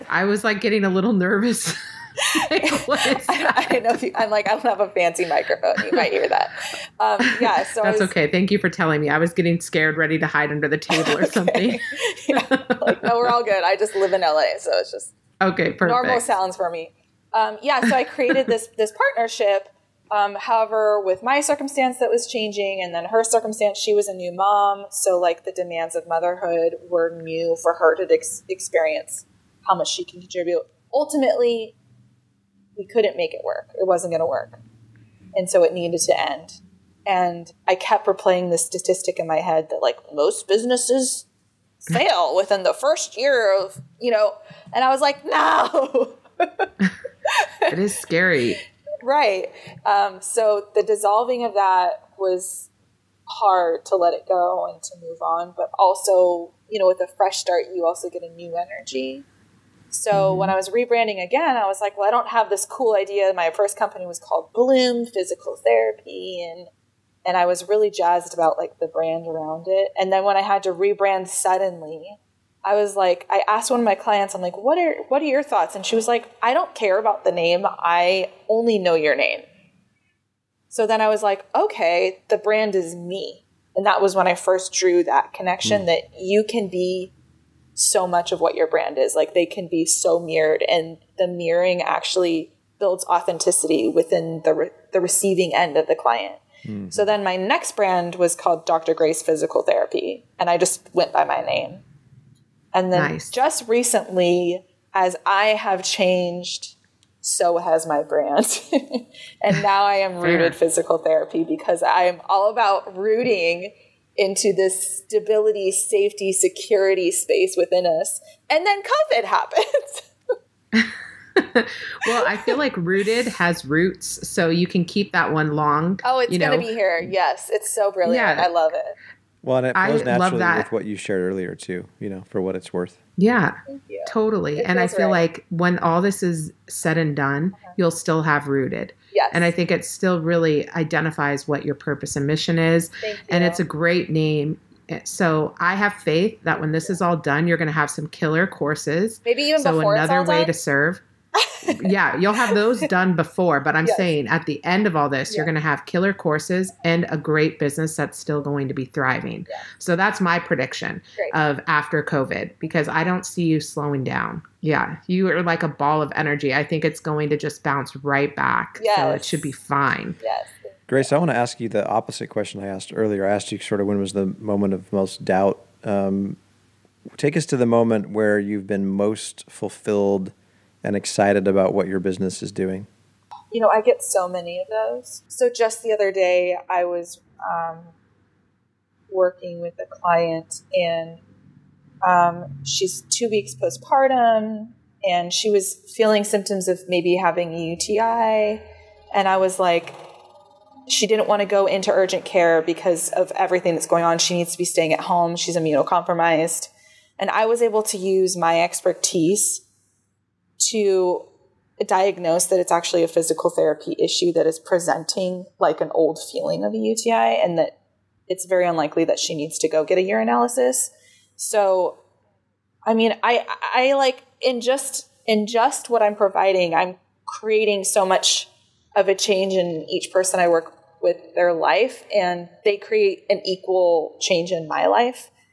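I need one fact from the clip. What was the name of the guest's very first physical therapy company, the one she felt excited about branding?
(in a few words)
Bloom Physical Therapy.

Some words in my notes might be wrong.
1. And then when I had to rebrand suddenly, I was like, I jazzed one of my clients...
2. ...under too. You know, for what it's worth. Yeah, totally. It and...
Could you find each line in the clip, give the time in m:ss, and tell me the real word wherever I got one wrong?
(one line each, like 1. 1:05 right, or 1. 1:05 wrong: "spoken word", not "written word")
1. 1:10 wrong: "asked", not "jazzed"
2. 2:11 wrong: "earlier", not "under".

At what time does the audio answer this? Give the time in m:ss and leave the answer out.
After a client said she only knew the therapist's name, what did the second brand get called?
1:38.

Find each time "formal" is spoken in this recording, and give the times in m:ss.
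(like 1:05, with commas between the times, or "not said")
not said.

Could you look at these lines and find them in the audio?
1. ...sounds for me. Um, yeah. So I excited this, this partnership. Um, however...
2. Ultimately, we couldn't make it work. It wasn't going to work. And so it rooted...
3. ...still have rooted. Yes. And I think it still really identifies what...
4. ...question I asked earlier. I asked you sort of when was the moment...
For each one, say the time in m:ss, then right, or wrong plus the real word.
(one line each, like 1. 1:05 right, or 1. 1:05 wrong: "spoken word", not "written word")
1. 0:16 wrong: "created", not "excited"
2. 0:30 wrong: "needed", not "rooted"
3. 2:17 right
4. 2:52 right.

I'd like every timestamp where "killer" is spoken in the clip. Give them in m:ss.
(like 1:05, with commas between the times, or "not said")
2:28, 2:35.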